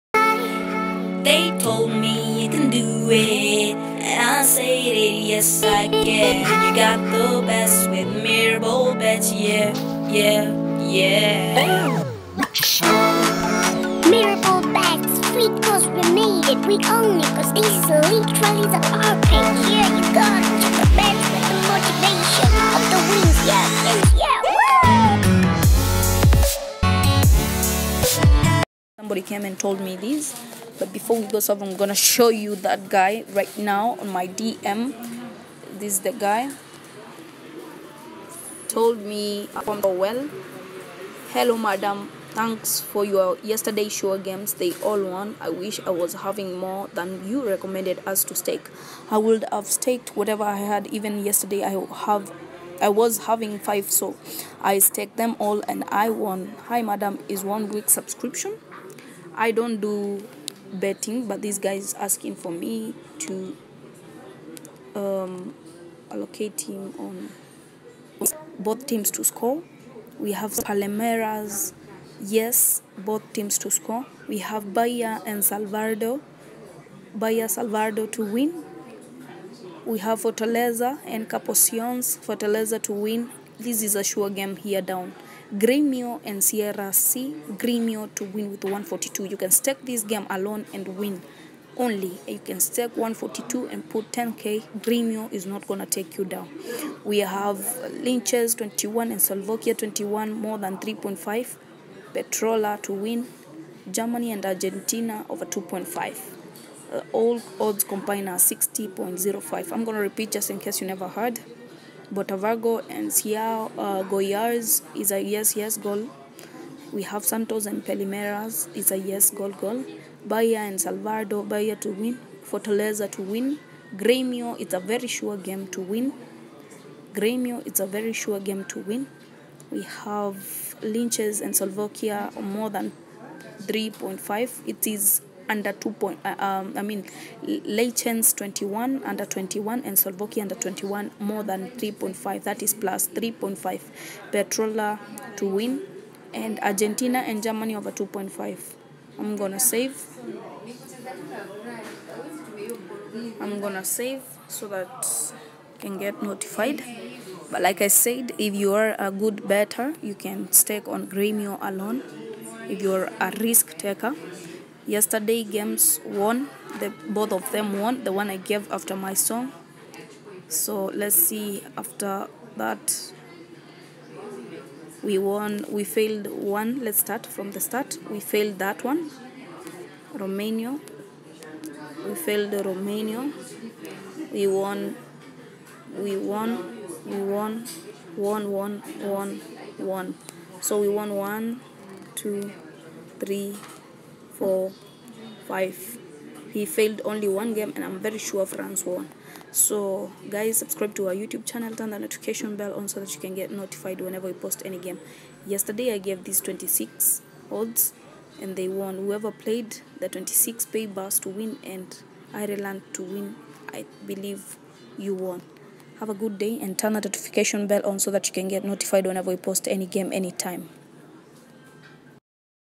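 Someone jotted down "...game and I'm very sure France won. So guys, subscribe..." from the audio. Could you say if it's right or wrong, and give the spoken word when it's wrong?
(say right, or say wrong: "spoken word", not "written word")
right.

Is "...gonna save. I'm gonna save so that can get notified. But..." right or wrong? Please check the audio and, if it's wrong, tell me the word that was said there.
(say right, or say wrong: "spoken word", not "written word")
right.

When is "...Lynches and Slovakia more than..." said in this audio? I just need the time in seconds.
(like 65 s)
130 s.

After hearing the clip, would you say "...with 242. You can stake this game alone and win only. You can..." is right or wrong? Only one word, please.
wrong.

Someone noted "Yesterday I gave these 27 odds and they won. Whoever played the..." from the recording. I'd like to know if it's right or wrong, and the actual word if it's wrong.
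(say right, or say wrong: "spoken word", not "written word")
wrong: "26", not "27".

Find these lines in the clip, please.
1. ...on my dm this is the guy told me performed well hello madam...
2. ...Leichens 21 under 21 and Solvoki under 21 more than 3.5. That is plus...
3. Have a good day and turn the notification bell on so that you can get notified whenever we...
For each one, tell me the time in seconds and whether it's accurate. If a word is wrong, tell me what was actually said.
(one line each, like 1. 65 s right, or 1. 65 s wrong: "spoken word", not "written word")
1. 34 s right
2. 137 s right
3. 215 s right.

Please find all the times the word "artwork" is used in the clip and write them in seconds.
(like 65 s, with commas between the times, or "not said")
not said.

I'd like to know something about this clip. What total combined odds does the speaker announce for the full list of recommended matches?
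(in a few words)
60.05.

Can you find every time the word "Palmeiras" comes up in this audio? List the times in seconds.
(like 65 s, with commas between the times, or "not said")
70 s, 117 s.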